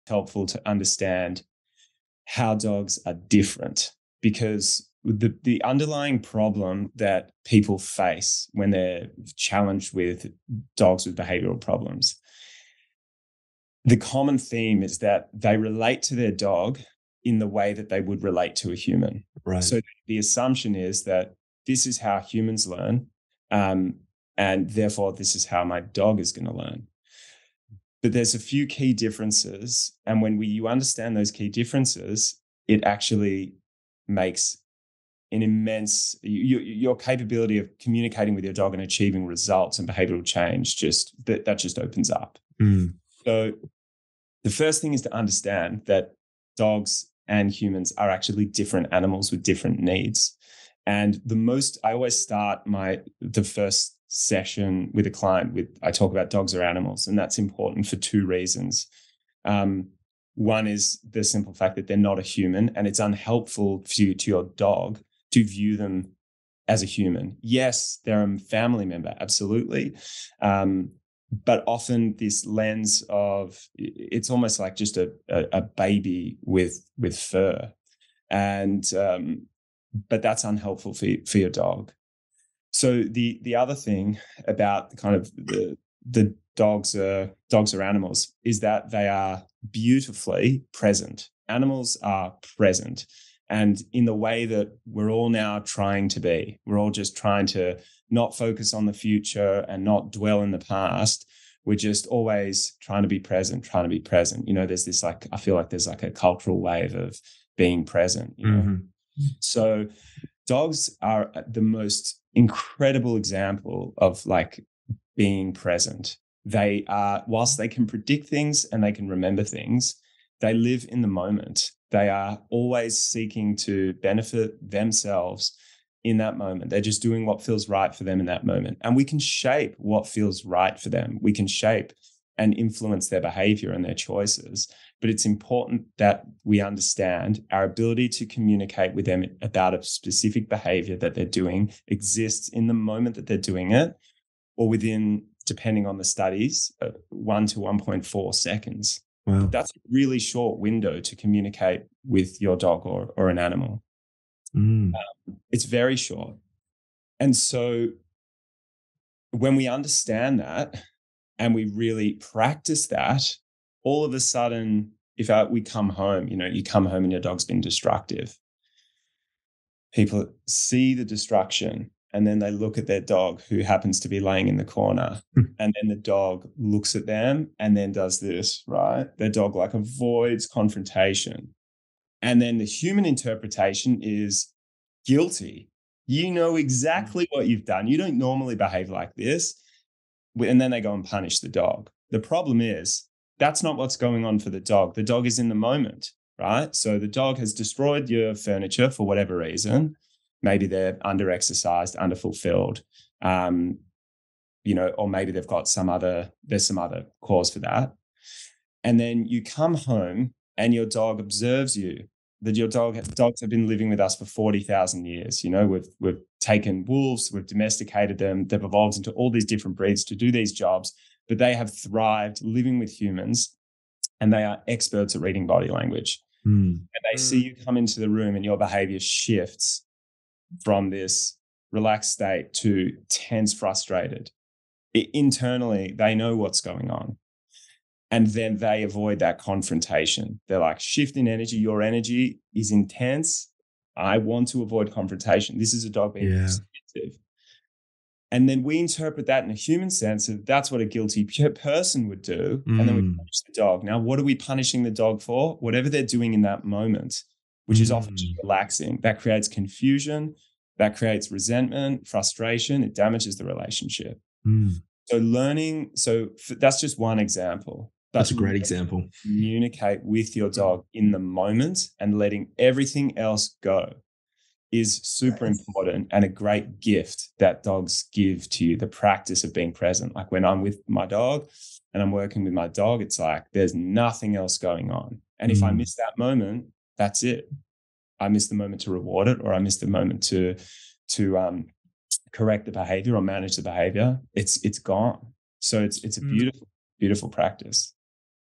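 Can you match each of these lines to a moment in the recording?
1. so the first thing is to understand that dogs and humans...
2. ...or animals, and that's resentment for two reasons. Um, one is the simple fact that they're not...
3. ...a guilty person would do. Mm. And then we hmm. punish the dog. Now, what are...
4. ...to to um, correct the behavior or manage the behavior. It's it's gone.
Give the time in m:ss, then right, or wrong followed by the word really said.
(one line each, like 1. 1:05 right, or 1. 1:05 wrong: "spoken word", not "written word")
1. 0:43 right
2. 0:56 wrong: "important", not "resentment"
3. 4:10 right
4. 4:50 right.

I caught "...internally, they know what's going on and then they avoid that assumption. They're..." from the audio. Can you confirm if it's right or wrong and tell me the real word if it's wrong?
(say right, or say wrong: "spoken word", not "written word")
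wrong: "confrontation", not "assumption".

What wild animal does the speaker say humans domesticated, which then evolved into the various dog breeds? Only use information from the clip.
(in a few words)
wolves.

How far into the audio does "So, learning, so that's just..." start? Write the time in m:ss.
4:25.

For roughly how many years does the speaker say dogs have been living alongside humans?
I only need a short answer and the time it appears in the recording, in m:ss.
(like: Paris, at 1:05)
40,000 years, at 3:34.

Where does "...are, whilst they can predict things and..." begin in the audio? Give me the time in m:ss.
1:56.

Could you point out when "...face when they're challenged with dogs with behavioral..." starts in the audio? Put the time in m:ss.
0:07.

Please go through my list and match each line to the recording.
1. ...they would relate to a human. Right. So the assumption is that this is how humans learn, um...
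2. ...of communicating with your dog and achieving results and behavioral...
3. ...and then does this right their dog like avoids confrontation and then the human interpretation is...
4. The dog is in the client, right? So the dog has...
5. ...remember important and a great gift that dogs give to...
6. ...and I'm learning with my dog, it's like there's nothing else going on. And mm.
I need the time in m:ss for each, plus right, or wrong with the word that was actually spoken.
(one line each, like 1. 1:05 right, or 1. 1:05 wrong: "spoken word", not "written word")
1. 0:17 right
2. 0:37 right
3. 2:57 right
4. 3:14 wrong: "moment", not "client"
5. 4:35 wrong: "super", not "remember"
6. 4:41 wrong: "working", not "learning".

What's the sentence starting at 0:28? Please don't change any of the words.
But there's a few key differences.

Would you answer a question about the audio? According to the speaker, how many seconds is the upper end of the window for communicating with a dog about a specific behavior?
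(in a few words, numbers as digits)
1.4 seconds.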